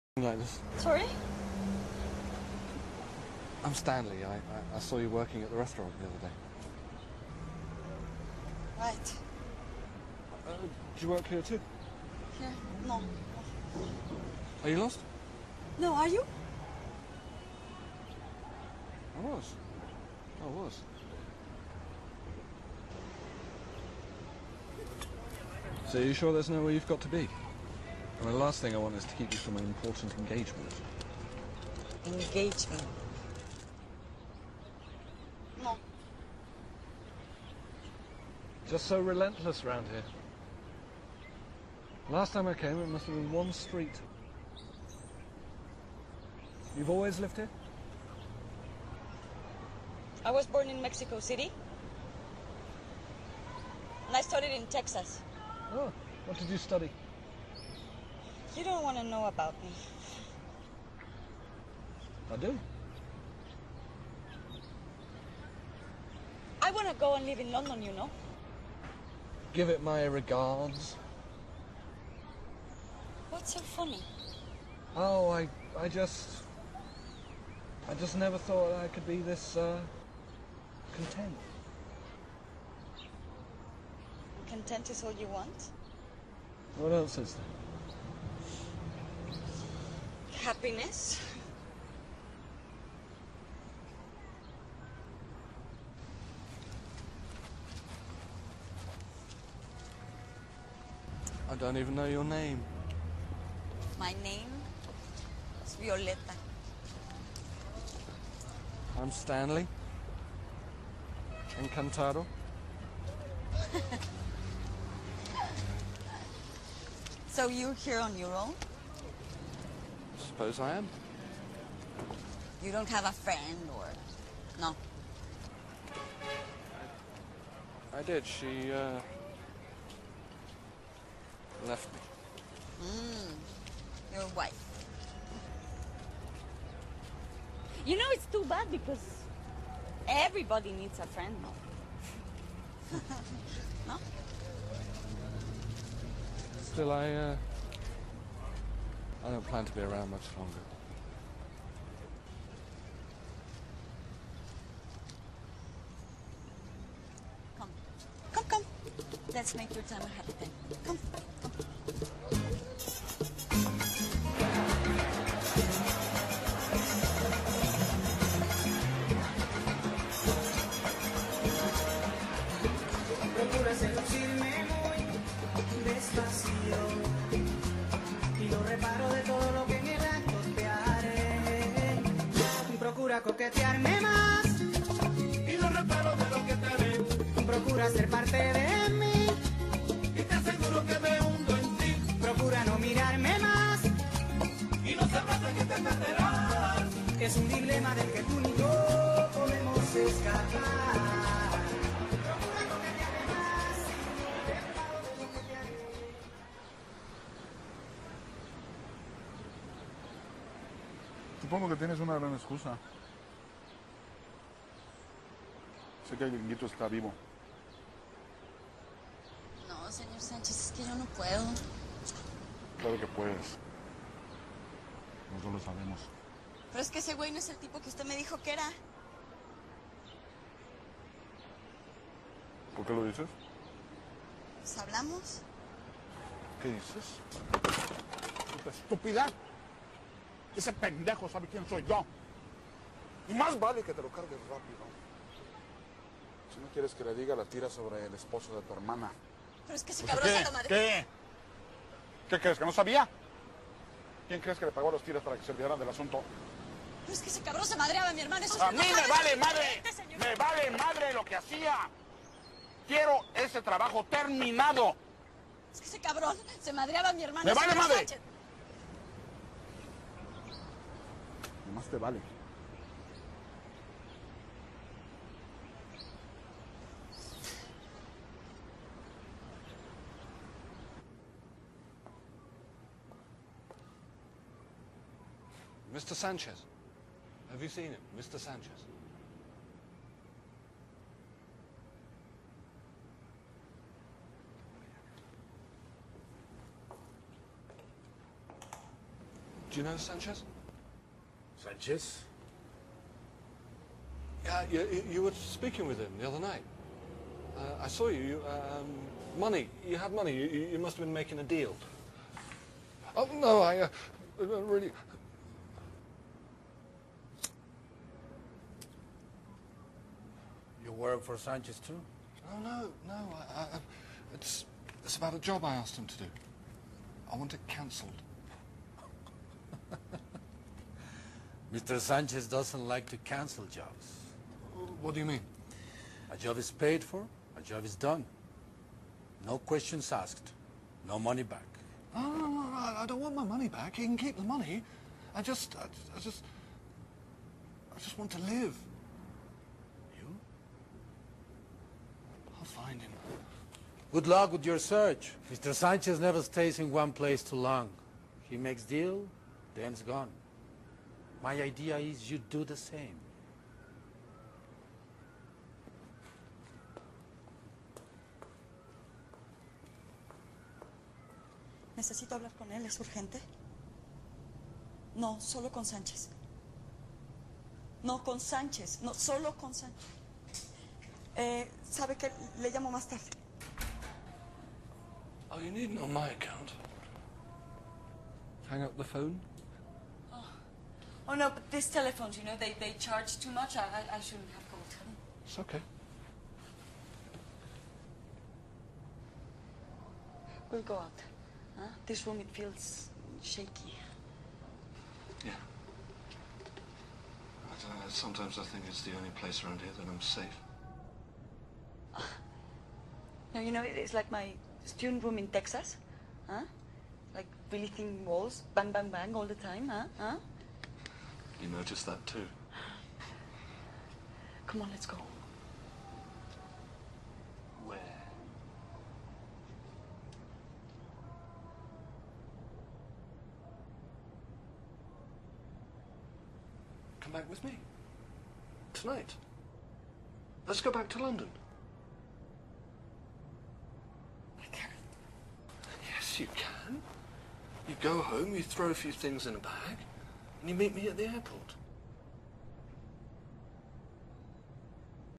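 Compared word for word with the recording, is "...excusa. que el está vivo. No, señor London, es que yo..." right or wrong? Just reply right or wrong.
wrong.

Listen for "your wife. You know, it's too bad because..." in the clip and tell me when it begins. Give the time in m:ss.
2:14.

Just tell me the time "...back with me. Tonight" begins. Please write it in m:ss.
7:17.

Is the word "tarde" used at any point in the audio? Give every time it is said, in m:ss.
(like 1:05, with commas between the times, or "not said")
6:23.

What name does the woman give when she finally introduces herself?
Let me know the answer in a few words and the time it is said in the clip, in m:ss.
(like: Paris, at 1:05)
Violetta, at 1:45.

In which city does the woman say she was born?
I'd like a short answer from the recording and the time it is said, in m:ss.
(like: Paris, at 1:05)
Mexico City, at 0:50.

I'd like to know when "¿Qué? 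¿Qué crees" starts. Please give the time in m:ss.
4:10.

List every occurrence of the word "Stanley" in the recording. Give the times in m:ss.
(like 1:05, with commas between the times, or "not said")
0:03, 1:49.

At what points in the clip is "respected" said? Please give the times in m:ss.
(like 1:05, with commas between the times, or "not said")
not said.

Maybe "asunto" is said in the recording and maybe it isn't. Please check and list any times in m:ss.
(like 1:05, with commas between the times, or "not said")
4:15.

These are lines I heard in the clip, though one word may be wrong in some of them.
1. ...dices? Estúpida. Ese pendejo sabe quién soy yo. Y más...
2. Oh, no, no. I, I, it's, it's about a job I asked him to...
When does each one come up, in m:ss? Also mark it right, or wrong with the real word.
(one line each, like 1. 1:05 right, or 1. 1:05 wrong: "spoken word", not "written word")
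1. 3:56 right
2. 5:22 right.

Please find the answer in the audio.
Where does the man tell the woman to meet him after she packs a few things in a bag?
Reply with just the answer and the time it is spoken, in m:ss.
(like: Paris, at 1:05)
the airport, at 7:31.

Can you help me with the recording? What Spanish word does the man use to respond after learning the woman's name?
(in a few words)
Encantado.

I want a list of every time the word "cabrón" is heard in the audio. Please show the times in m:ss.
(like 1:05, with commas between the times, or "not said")
4:10, 4:17, 4:26.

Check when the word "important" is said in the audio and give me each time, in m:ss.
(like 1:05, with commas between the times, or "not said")
0:29.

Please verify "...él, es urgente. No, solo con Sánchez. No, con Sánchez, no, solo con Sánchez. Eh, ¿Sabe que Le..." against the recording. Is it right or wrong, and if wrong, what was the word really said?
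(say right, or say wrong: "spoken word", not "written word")
right.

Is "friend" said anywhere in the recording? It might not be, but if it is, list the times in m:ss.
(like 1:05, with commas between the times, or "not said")
2:03, 2:21.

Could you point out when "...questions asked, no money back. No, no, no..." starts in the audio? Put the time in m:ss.
5:39.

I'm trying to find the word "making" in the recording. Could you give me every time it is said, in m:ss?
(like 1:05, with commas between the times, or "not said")
5:11.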